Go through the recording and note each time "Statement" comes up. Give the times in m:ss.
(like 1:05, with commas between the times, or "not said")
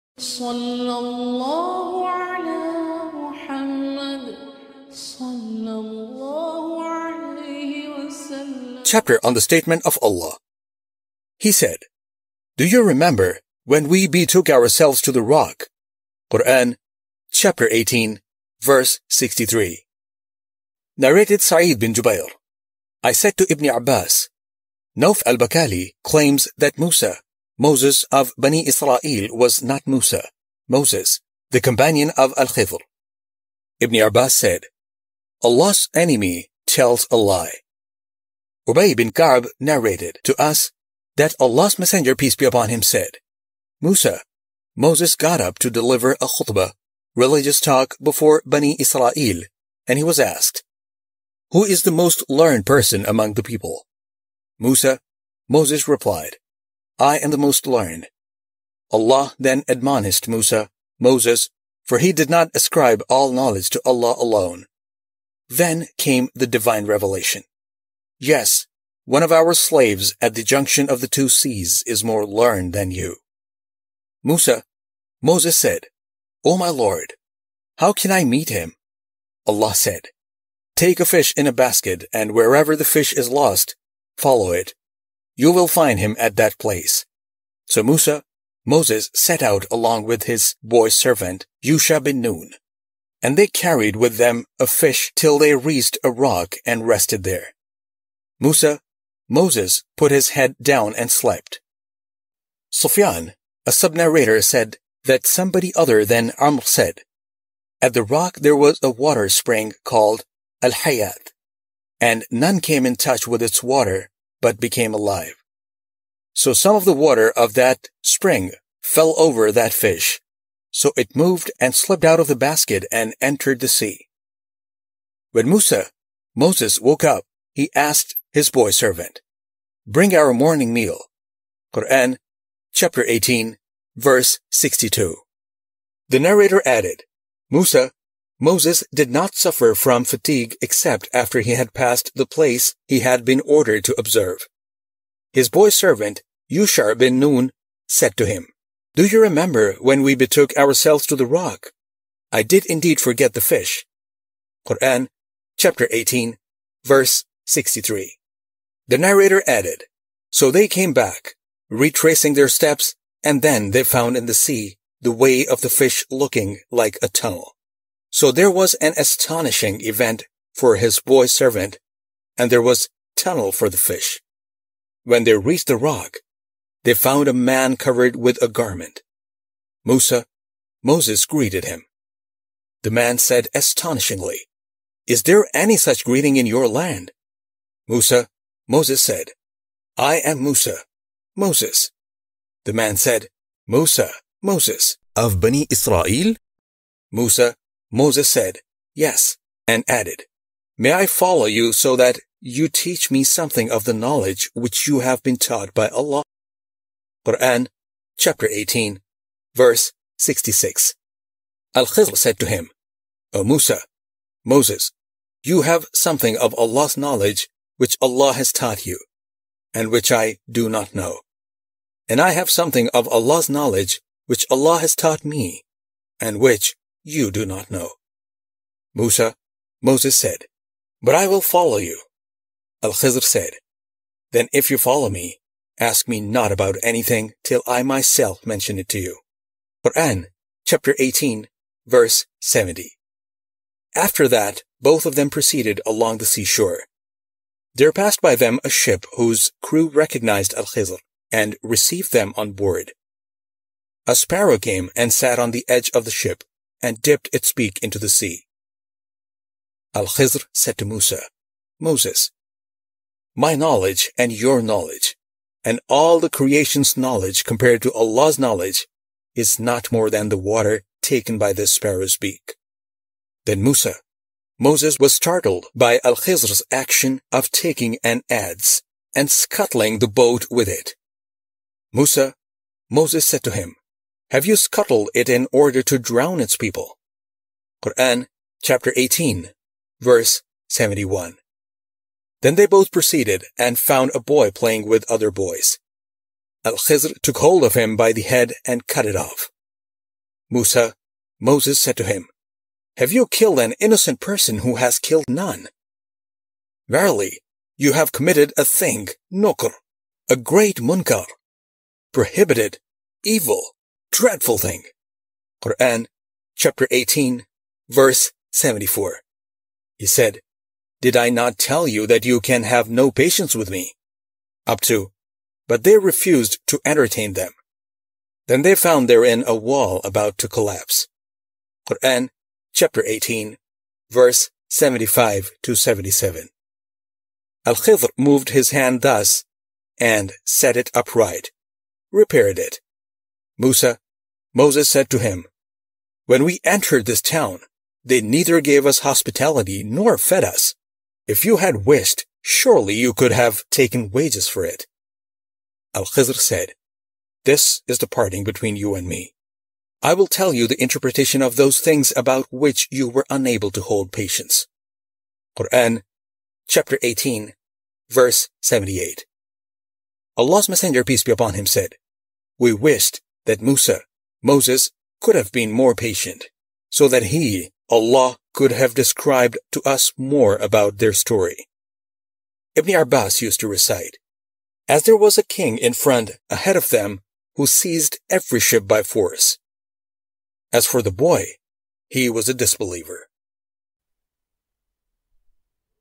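0:09.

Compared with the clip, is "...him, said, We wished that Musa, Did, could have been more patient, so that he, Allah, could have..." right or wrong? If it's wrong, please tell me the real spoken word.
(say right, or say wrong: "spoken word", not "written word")
wrong: "Moses", not "Did".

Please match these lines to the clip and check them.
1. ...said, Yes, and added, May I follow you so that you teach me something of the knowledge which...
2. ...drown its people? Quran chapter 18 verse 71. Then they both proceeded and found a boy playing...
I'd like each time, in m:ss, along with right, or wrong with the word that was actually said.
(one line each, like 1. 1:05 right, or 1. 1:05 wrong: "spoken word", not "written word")
1. 3:18 right
2. 4:45 right.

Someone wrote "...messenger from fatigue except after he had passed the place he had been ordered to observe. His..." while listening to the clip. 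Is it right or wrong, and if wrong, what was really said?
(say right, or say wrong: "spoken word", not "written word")
wrong: "suffer", not "messenger".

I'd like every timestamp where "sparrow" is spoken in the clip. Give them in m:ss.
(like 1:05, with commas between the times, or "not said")
4:14, 4:31.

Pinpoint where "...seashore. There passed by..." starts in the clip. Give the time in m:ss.
4:06.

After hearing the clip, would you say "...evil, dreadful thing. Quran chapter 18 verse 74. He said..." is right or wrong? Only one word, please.
right.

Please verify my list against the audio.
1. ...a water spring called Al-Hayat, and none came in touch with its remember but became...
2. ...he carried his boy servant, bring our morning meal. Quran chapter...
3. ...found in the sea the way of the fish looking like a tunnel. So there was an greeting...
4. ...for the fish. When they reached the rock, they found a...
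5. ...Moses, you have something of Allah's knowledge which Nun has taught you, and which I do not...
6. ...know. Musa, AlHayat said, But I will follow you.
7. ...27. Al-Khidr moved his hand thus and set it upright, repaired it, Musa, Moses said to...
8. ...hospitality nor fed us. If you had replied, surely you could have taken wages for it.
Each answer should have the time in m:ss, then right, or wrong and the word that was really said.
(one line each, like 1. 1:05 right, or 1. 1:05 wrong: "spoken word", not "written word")
1. 1:48 wrong: "water", not "remember"
2. 2:07 wrong: "asked", not "carried"
3. 2:43 wrong: "astonishing", not "greeting"
4. 2:53 right
5. 3:34 wrong: "Allah", not "Nun"
6. 3:47 wrong: "Moses", not "AlHayat"
7. 5:35 wrong: "77", not "27"
8. 5:48 wrong: "wished", not "replied".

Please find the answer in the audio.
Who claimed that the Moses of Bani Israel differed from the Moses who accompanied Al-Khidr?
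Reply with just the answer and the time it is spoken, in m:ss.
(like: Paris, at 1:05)
Nauf al-Bakali, at 0:24.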